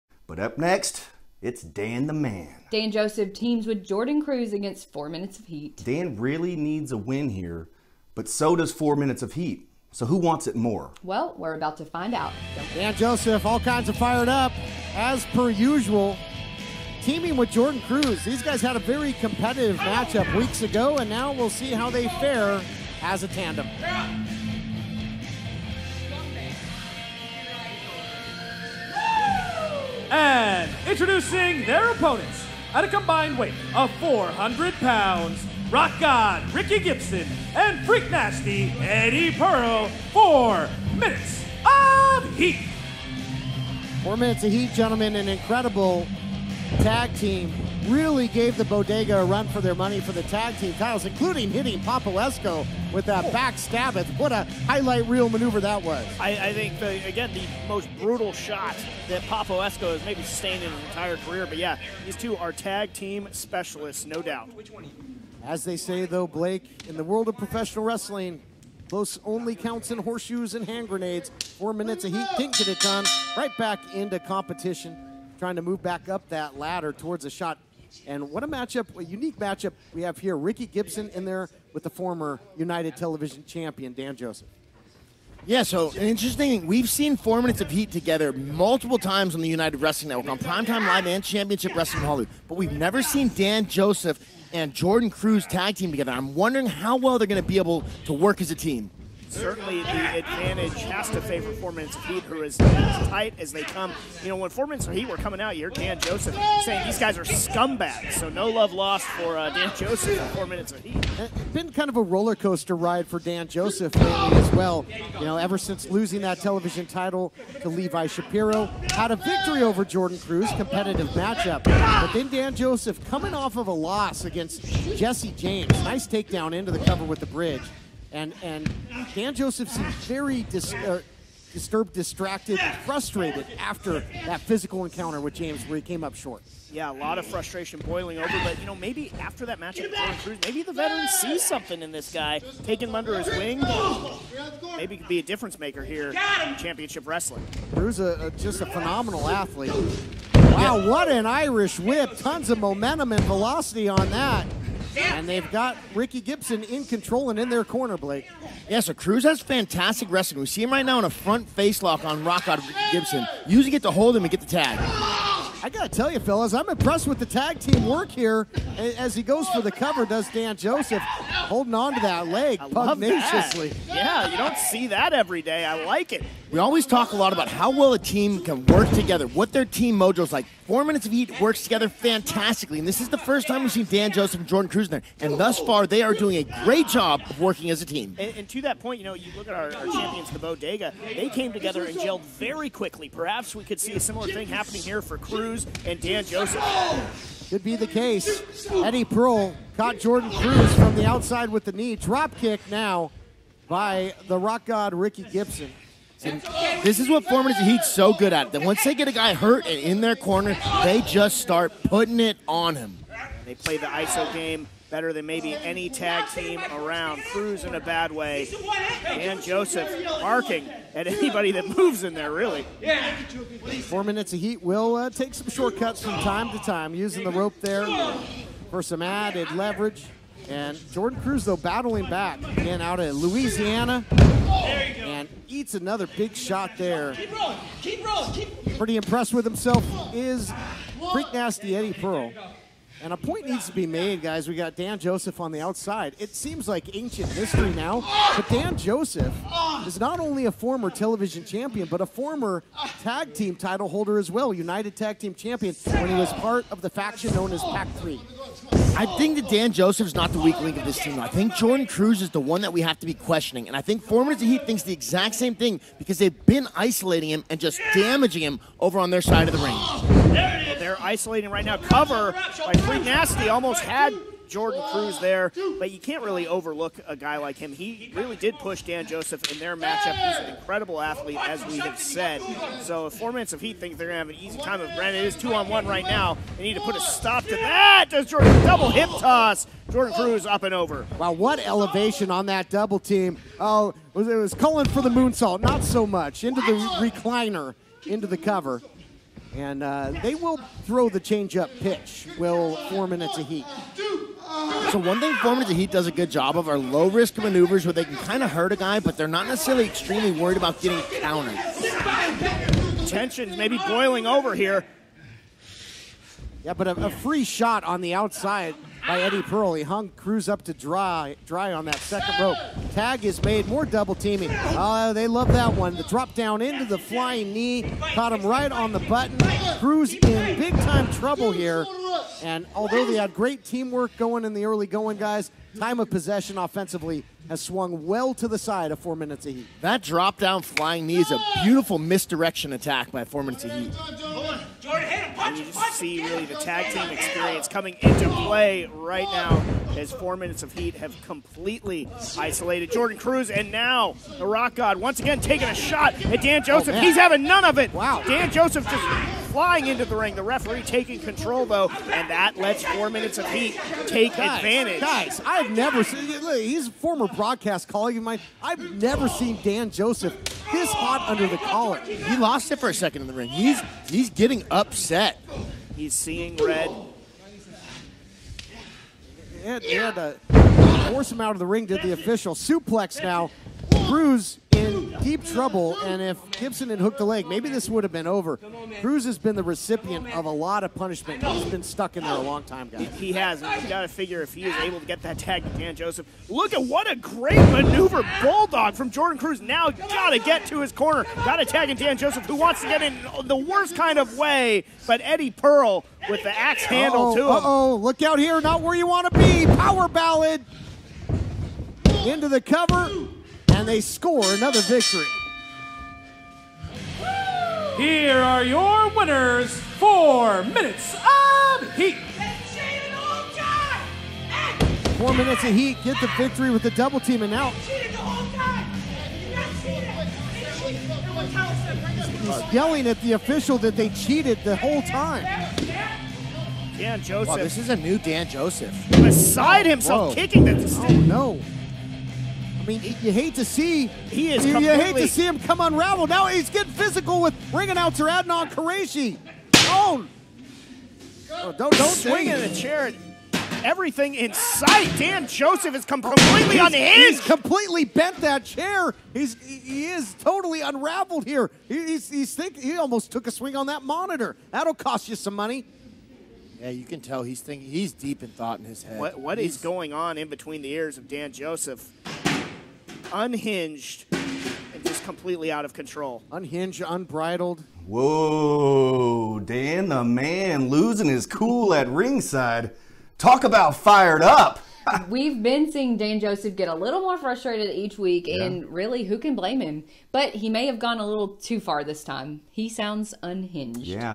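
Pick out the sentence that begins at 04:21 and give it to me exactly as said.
I think Jordan Cruz is the one that we have to be questioning.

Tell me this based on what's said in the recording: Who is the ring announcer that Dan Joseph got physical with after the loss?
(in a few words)
Adnan Qureshi.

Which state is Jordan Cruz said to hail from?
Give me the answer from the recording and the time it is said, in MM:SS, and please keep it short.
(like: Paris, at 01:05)
Louisiana, at 03:53.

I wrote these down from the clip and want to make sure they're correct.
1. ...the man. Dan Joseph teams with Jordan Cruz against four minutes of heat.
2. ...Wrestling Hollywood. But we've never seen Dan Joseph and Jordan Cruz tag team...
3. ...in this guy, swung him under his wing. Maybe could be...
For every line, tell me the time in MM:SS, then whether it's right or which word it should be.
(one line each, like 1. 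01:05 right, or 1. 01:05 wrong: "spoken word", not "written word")
1. 00:02 right
2. 01:31 right
3. 02:21 wrong: "taking", not "swung".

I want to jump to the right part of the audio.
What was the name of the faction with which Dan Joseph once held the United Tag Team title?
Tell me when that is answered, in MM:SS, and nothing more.
04:17.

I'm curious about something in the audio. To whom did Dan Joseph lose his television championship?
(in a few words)
Levi Shapiro.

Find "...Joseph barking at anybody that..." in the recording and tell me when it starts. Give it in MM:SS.
03:39.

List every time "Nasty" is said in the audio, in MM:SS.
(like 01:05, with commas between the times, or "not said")
00:38, 04:01, 04:33.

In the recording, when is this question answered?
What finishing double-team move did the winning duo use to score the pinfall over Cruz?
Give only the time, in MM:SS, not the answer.
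06:49.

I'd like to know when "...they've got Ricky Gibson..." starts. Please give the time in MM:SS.
02:35.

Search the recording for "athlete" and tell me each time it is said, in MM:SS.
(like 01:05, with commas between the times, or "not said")
02:29, 04:40.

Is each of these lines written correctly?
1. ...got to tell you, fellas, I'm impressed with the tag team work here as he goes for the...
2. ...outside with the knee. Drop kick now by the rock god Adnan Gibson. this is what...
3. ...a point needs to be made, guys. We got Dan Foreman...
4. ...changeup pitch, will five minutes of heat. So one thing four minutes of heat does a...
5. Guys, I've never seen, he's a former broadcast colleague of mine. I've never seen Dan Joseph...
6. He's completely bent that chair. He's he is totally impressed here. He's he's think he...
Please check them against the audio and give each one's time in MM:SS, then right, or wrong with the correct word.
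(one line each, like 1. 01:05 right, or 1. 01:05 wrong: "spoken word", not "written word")
1. 02:45 right
2. 03:21 wrong: "Ricky", not "Adnan"
3. 04:03 wrong: "Joseph", not "Foreman"
4. 05:01 wrong: "four", not "five"
5. 06:05 right
6. 07:37 wrong: "unraveled", not "impressed".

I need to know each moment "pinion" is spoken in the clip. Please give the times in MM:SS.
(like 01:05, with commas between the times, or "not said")
not said.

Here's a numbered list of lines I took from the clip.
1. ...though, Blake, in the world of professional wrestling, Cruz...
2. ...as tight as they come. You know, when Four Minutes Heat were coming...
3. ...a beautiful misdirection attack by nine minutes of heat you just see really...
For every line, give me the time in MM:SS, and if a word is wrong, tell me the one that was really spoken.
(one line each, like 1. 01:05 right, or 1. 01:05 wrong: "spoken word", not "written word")
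1. 01:06 wrong: "Close", not "Cruz"
2. 01:42 right
3. 05:41 wrong: "four", not "nine".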